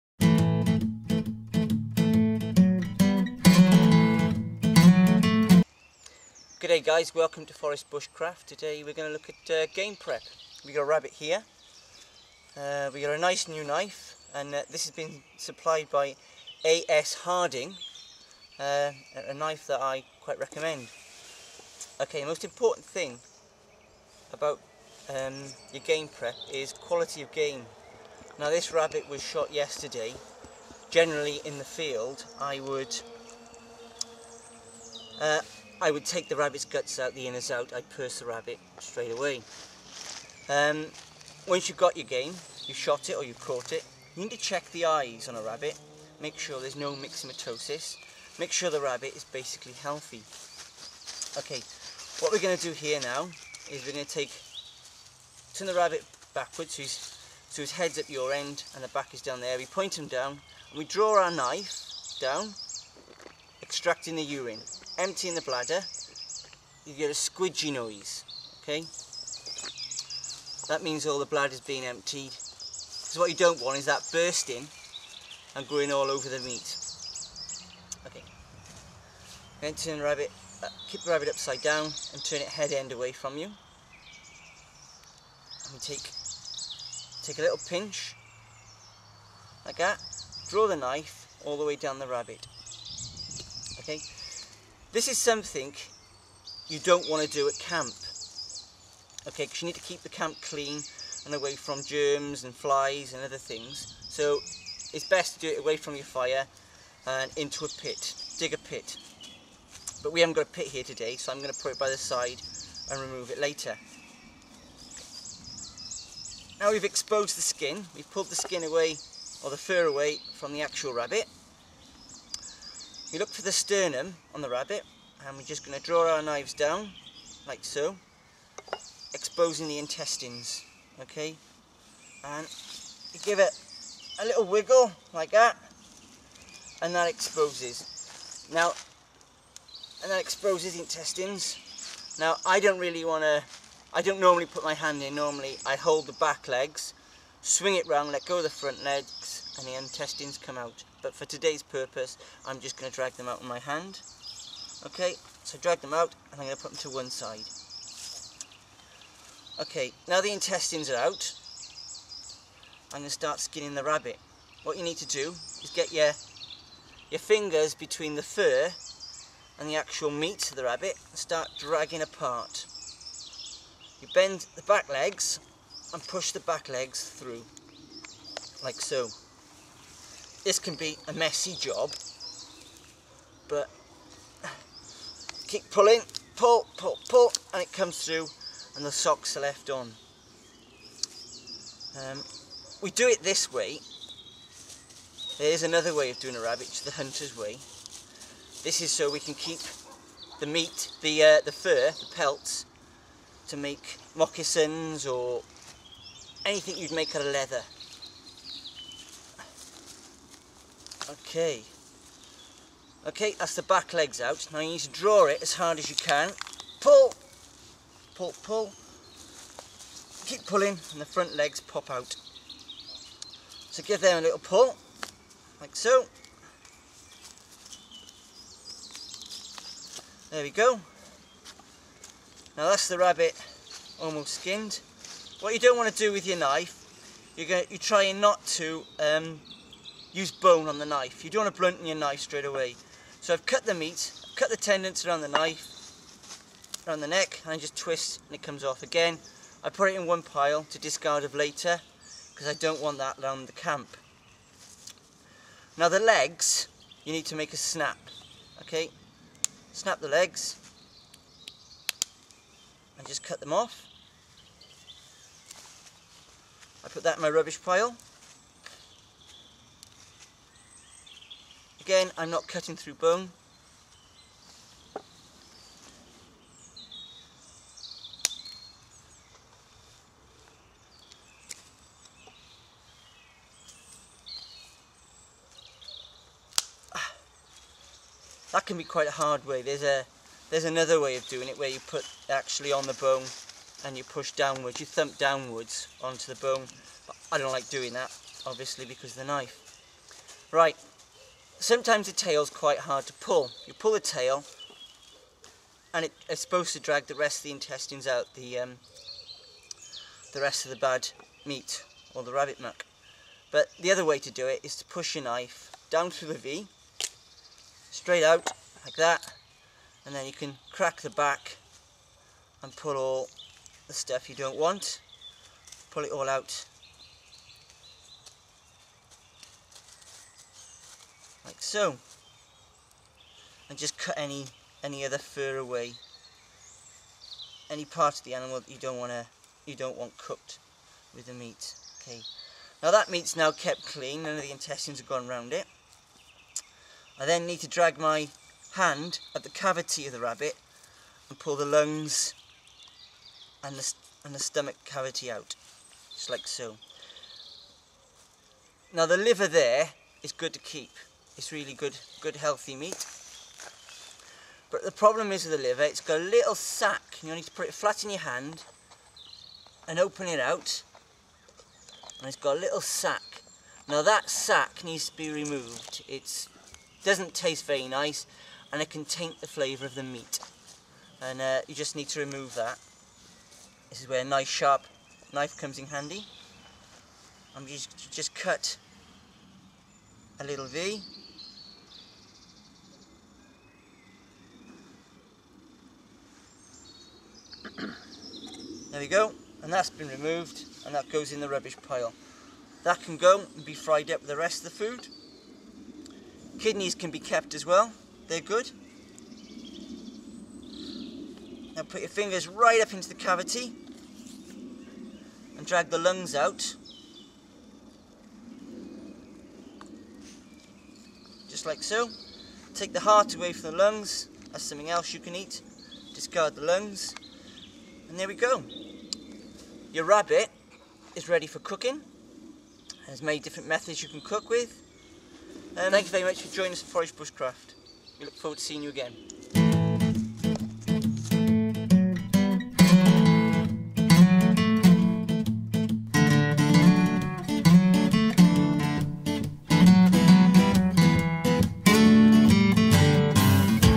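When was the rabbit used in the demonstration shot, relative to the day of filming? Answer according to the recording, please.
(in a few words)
Yesterday.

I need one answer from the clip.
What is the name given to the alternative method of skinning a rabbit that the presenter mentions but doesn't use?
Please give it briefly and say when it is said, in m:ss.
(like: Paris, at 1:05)
The hunter's way, at 3:16.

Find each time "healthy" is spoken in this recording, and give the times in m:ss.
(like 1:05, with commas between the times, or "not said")
0:49, 6:02.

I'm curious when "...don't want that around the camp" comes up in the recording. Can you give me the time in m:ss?
4:12.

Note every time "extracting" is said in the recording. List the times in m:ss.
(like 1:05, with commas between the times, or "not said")
1:03.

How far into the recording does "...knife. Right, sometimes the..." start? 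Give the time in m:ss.
4:59.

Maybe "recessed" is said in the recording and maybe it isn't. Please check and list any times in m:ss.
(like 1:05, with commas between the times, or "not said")
not said.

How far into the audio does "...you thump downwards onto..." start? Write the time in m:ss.
4:54.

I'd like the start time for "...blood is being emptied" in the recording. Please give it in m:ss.
1:11.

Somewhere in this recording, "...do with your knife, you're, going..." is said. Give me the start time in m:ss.
3:55.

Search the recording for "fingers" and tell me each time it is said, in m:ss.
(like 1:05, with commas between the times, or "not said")
2:47, 6:52.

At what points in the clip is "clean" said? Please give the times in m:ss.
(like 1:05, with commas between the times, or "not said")
1:40, 5:43.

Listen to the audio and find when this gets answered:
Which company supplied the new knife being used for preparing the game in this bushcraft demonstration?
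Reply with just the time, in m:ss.
0:16.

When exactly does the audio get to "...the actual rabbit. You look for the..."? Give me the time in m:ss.
2:00.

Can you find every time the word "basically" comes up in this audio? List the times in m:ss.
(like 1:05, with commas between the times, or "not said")
0:49.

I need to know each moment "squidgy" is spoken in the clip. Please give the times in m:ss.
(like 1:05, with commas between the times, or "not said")
1:07.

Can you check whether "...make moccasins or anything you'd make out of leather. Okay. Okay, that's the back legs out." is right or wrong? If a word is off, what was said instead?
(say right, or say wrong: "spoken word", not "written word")
right.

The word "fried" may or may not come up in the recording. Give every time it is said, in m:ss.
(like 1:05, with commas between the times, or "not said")
6:43.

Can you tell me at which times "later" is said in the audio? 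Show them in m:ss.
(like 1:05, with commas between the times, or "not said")
1:53, 4:11.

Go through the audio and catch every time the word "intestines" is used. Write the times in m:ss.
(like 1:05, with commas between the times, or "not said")
2:09, 2:20, 2:29, 2:40, 5:07, 5:44.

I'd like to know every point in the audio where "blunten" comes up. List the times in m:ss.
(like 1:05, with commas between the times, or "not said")
4:01.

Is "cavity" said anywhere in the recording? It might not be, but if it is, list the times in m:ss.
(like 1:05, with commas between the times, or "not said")
5:49, 5:54, 6:53.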